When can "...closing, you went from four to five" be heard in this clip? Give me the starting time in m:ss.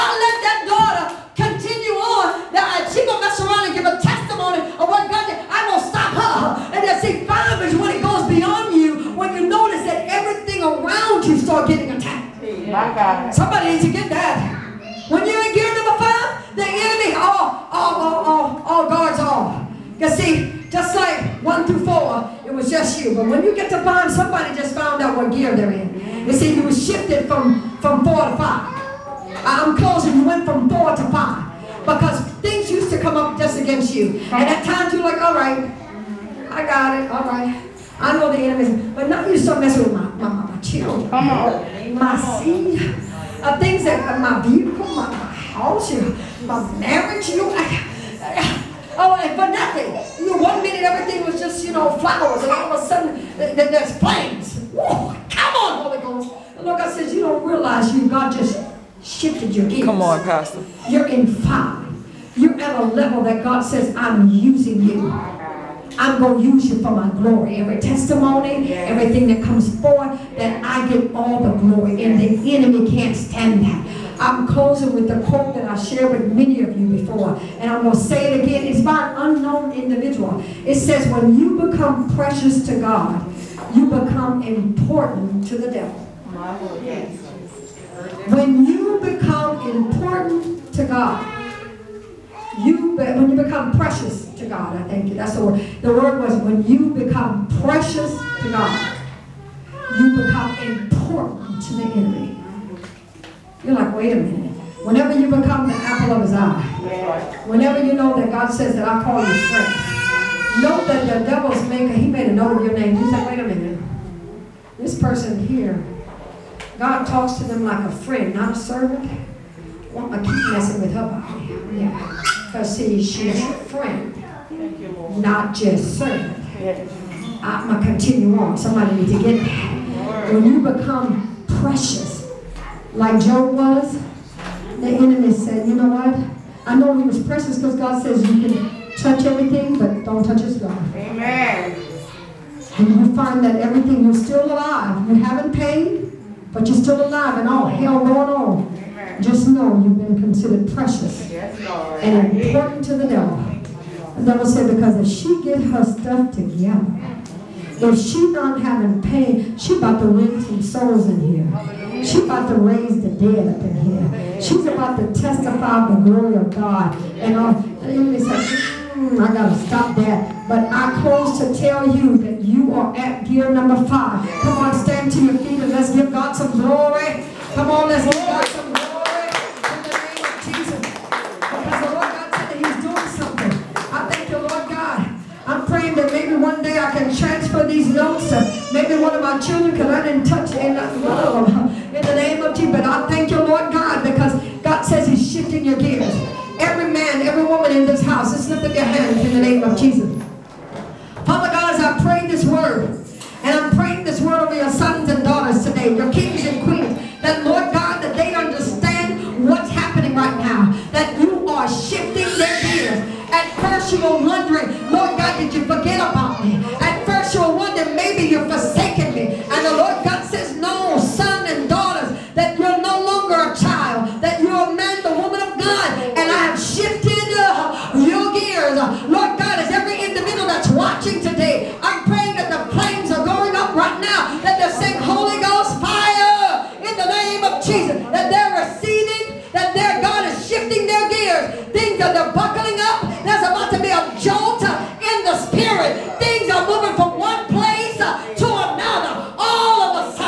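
0:29.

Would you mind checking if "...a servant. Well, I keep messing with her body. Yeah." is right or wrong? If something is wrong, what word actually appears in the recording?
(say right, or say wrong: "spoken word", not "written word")
right.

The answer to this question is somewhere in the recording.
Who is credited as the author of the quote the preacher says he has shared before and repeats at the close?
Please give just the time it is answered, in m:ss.
1:19.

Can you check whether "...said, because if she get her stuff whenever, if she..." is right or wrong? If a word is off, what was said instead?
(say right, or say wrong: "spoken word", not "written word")
wrong: "together", not "whenever".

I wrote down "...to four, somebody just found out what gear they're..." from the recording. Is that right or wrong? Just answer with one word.
wrong.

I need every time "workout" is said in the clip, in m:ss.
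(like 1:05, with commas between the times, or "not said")
not said.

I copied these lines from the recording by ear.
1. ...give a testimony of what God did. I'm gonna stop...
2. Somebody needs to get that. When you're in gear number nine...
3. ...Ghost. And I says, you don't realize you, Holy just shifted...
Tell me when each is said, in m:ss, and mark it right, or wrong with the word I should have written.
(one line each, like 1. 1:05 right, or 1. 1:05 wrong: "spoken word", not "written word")
1. 0:03 right
2. 0:13 wrong: "five", not "nine"
3. 0:56 wrong: "God", not "Holy".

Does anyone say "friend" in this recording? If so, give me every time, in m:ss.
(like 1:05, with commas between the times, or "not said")
1:49, 1:57, 2:03.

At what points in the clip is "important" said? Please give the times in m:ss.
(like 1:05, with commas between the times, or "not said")
1:24, 1:29, 1:40, 2:32.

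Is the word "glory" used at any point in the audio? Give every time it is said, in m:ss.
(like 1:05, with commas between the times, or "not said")
1:07, 1:11, 2:46, 2:56.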